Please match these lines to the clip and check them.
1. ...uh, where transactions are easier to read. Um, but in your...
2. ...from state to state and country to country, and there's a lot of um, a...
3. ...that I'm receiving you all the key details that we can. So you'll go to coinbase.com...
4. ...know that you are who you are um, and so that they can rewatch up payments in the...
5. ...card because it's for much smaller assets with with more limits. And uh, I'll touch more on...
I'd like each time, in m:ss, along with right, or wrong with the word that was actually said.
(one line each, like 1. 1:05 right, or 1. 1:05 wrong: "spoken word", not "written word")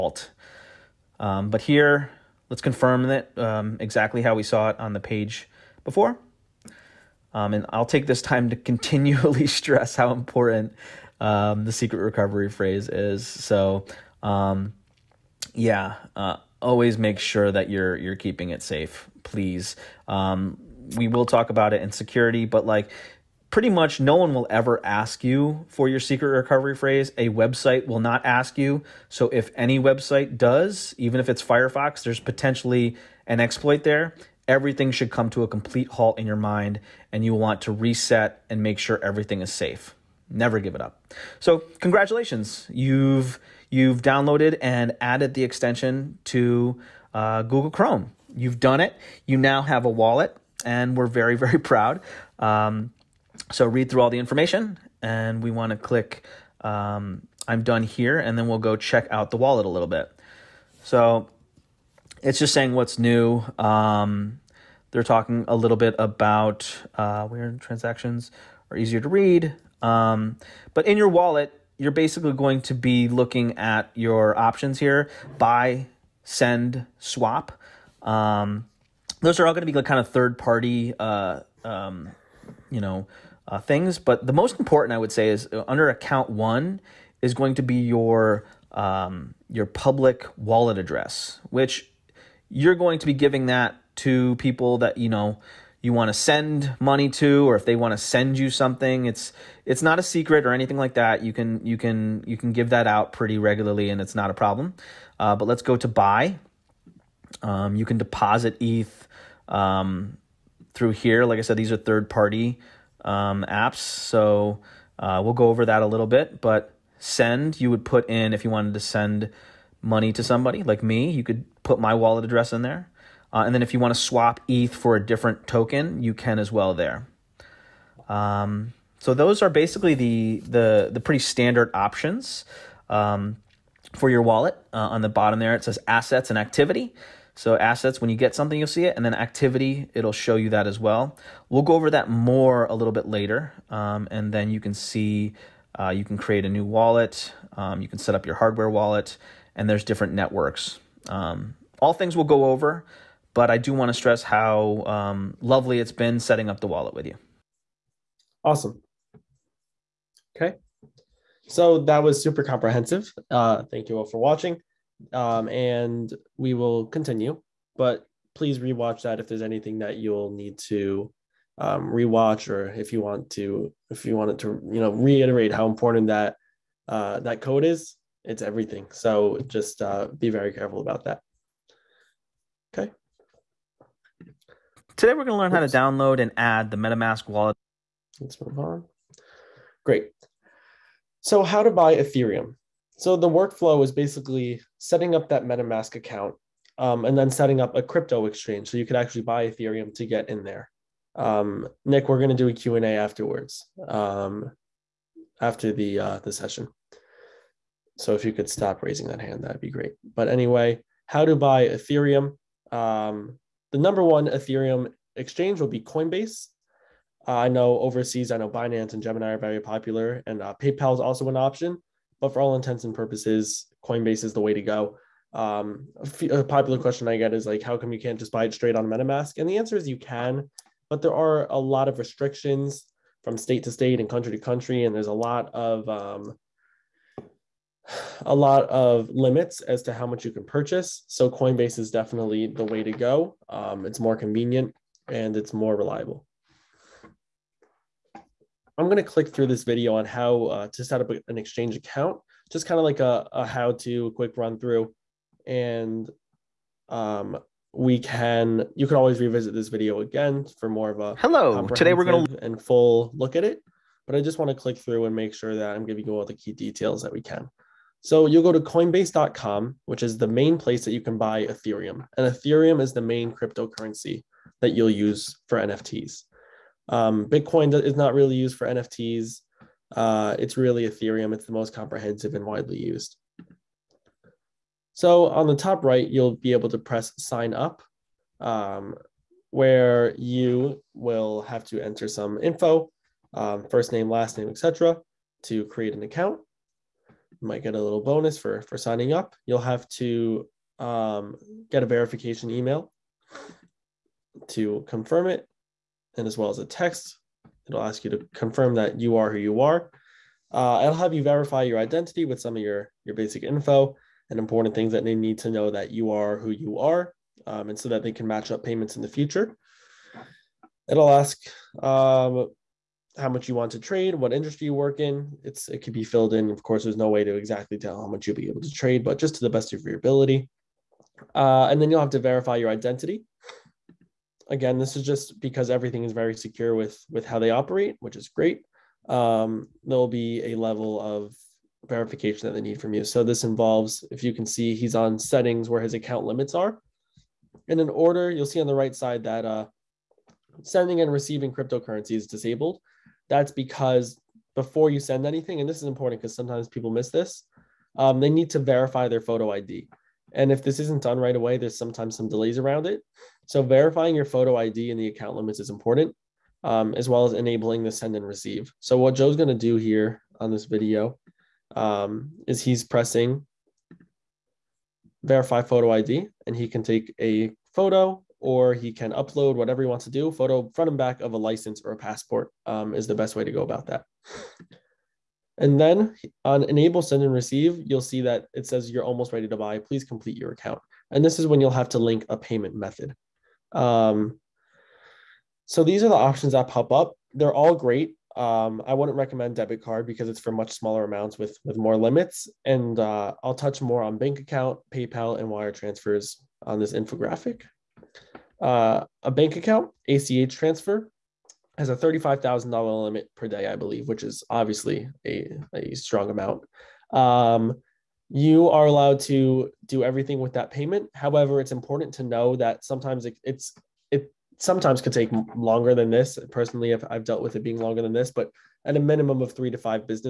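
1. 1:06 right
2. 3:53 right
3. 4:25 wrong: "giving", not "receiving"
4. 5:15 wrong: "match", not "rewatch"
5. 6:39 wrong: "amounts", not "assets".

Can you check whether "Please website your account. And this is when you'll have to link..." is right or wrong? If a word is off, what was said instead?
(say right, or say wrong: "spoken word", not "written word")
wrong: "complete", not "website".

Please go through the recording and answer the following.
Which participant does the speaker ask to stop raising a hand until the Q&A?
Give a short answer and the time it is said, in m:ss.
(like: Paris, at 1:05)
Nick, at 3:21.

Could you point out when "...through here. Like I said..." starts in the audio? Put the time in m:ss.
1:50.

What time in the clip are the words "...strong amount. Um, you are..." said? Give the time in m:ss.
6:55.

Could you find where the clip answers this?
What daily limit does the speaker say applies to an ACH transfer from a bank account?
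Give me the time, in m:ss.
6:51.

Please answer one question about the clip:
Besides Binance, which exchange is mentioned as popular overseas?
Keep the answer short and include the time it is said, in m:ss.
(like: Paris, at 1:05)
Gemini, at 3:39.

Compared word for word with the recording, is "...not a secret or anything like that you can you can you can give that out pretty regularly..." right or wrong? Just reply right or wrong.
right.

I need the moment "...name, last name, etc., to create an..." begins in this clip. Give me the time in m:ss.
4:53.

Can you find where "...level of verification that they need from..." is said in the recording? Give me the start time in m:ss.
5:40.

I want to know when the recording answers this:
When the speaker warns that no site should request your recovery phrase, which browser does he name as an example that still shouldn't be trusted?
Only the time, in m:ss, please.
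0:31.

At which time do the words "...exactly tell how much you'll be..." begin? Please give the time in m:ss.
5:27.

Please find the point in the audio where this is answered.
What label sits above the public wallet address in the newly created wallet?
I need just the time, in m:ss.
1:25.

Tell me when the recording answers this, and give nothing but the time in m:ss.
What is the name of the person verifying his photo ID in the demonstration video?
6:09.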